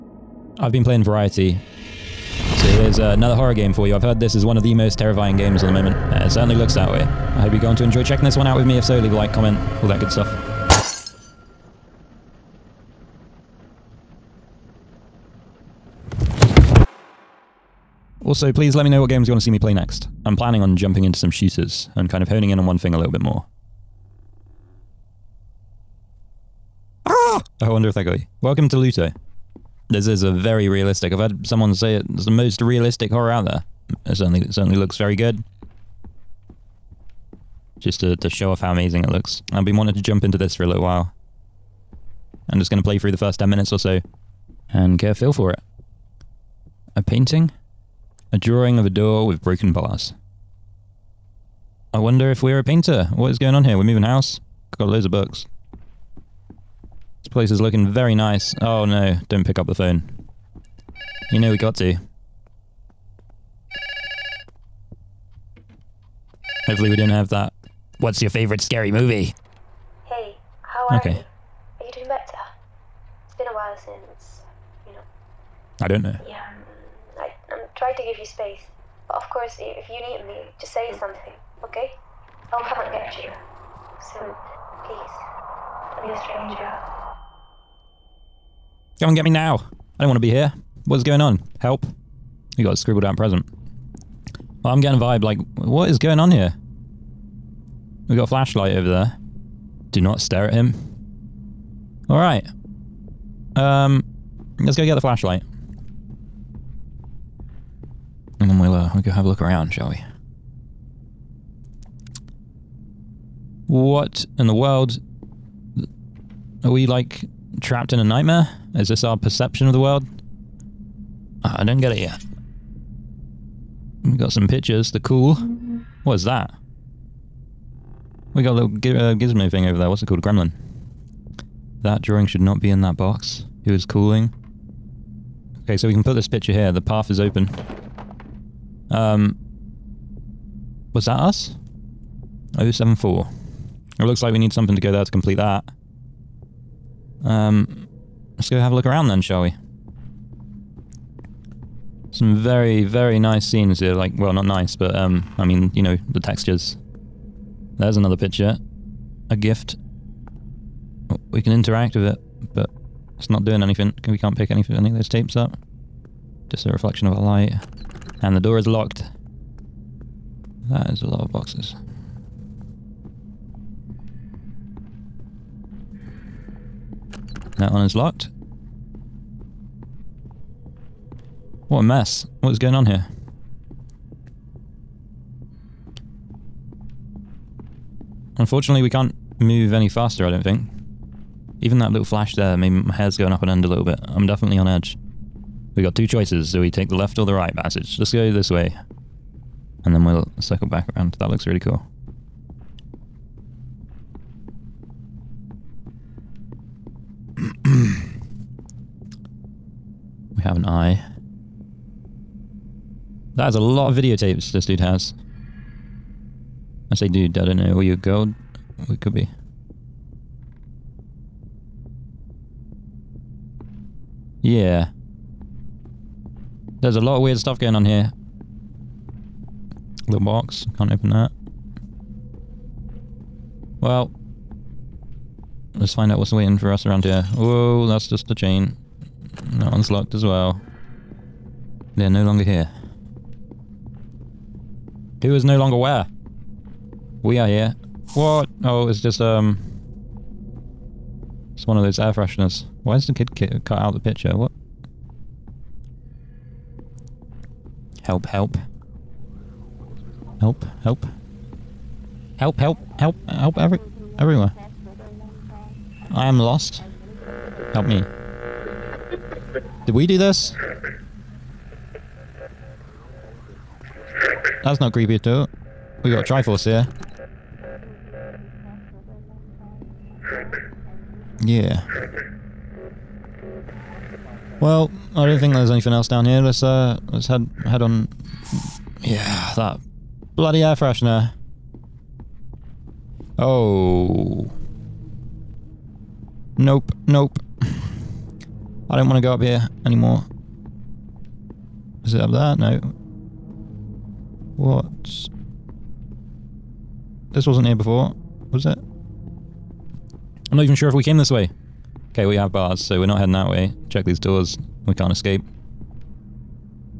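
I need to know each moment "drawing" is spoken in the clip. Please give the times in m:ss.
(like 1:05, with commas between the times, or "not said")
0:48, 2:12.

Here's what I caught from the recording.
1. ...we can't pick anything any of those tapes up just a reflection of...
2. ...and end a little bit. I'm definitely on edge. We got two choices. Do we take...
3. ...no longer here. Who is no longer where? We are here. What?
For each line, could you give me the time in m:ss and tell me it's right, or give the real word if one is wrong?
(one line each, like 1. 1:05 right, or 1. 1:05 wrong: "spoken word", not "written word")
1. 2:44 right
2. 3:13 right
3. 4:02 right.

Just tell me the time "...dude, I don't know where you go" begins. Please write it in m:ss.
3:37.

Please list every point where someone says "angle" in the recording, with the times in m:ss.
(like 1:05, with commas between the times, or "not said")
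not said.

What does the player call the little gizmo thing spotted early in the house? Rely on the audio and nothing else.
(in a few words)
A gremlin.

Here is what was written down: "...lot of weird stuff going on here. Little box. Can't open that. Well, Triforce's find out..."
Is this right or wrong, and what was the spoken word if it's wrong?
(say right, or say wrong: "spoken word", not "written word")
wrong: "Let", not "Triforce".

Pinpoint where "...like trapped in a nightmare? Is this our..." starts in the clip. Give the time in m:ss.
1:56.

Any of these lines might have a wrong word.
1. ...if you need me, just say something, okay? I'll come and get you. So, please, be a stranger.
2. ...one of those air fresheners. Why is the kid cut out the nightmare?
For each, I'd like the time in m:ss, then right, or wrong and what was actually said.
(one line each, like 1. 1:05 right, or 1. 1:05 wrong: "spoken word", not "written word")
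1. 1:19 right
2. 4:11 wrong: "picture", not "nightmare".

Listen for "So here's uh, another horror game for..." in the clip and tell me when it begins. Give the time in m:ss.
0:02.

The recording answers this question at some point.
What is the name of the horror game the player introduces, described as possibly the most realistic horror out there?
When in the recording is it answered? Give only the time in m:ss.
0:28.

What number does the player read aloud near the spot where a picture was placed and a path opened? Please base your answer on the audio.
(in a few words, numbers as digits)
074.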